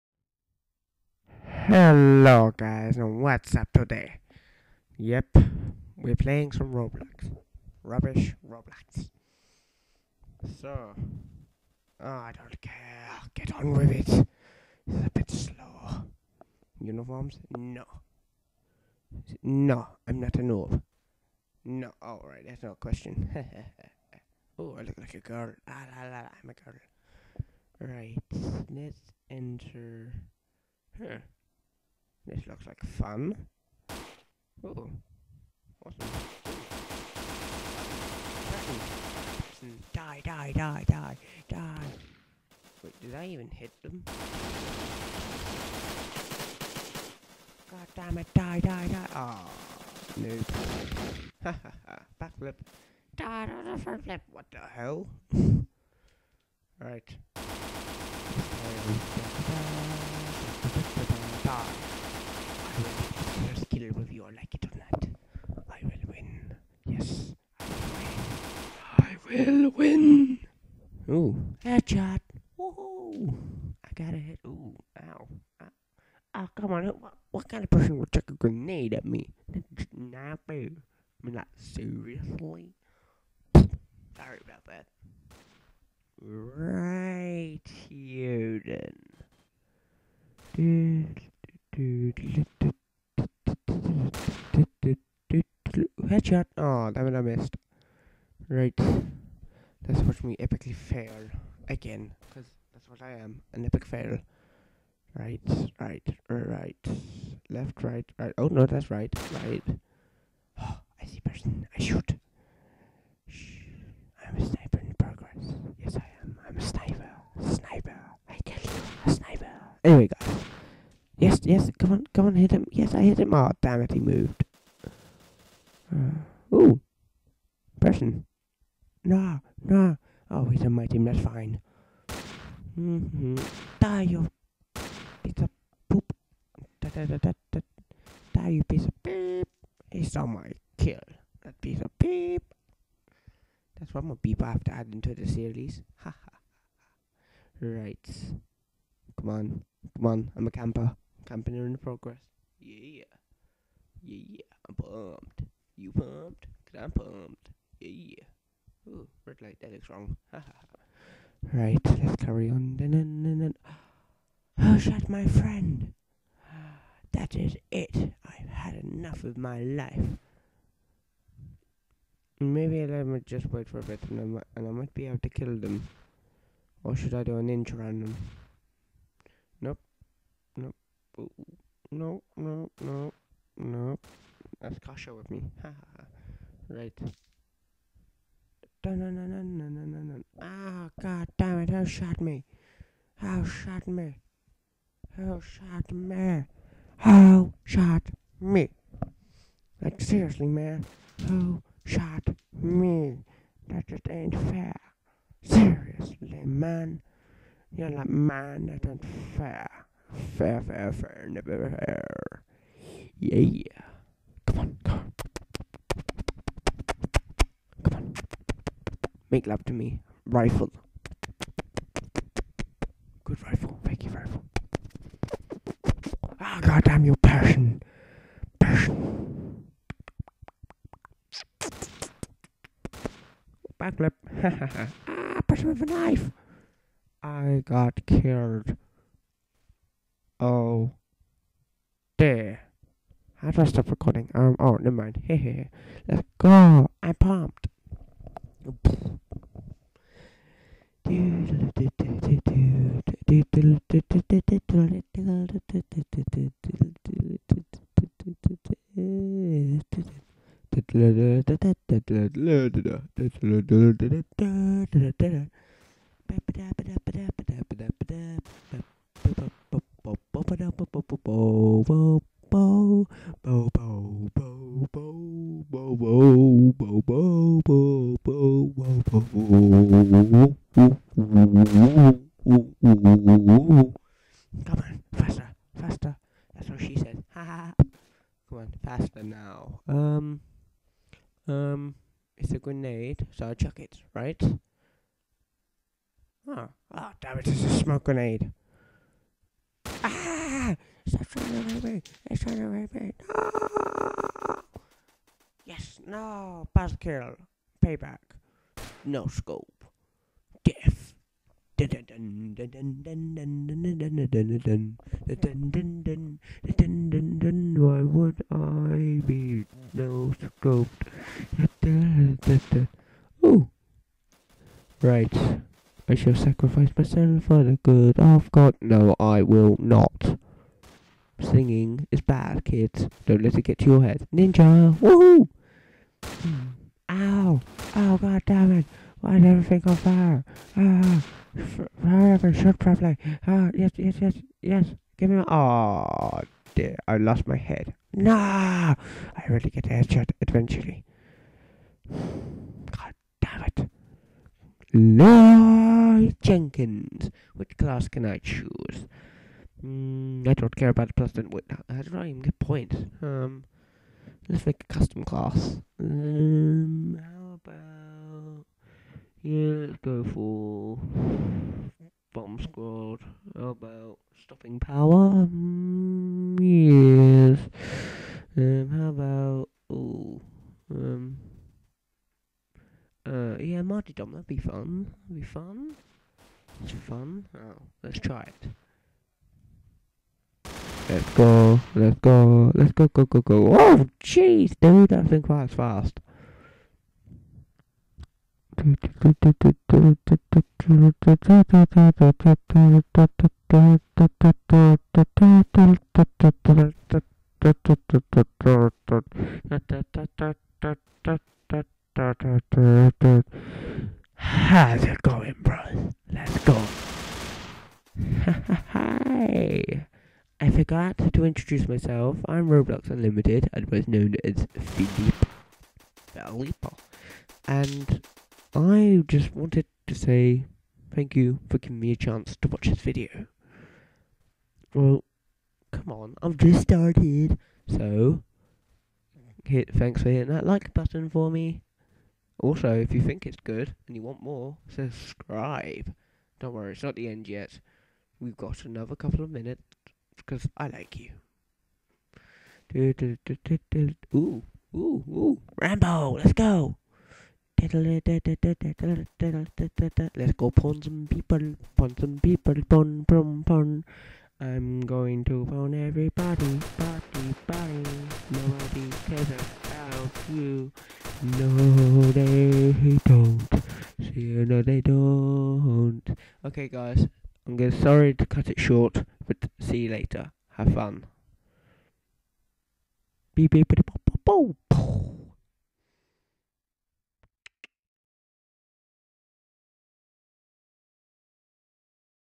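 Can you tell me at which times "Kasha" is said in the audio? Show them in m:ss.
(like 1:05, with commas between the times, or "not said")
3:04.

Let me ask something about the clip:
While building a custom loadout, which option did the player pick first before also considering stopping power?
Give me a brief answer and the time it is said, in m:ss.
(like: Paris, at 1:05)
Bomb squad, at 6:12.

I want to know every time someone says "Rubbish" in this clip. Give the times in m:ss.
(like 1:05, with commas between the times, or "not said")
0:07.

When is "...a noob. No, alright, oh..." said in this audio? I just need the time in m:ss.
0:20.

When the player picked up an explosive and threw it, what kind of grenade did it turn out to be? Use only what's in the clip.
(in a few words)
Smoke grenade.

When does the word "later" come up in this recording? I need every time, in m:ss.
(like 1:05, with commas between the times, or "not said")
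8:00.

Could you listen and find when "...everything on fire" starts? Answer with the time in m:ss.
5:39.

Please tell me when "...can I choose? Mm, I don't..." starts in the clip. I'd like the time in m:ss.
5:58.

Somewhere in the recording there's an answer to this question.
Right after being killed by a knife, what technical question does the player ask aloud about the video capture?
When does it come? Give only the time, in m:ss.
4:03.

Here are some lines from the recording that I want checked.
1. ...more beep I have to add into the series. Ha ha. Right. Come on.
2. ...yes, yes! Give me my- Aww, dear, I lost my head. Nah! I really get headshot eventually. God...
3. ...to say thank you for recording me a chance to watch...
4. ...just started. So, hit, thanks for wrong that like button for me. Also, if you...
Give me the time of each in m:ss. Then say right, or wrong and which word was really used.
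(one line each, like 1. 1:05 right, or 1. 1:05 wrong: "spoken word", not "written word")
1. 2:24 right
2. 5:44 right
3. 7:10 wrong: "giving", not "recording"
4. 7:16 wrong: "hitting", not "wrong".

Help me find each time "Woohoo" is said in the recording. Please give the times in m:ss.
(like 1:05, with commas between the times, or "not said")
1:12, 5:34.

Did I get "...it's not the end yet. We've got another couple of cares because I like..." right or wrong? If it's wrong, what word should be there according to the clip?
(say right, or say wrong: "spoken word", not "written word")
wrong: "minutes", not "cares".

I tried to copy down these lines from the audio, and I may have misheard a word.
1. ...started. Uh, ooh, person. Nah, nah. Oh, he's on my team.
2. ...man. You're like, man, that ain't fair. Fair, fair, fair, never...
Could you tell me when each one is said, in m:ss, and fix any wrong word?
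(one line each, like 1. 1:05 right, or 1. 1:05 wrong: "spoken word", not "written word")
1. 2:03 wrong: "moved", not "started"
2. 3:26 right.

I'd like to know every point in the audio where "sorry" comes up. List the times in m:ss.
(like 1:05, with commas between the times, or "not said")
1:24, 7:57.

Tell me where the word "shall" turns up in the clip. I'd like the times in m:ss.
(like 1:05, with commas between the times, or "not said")
5:26.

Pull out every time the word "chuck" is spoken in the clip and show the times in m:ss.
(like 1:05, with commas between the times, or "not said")
1:18, 4:53.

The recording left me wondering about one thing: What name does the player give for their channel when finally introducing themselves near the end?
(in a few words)
Roblox Unlimited.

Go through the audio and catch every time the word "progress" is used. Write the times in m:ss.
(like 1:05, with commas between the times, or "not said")
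1:54, 2:31.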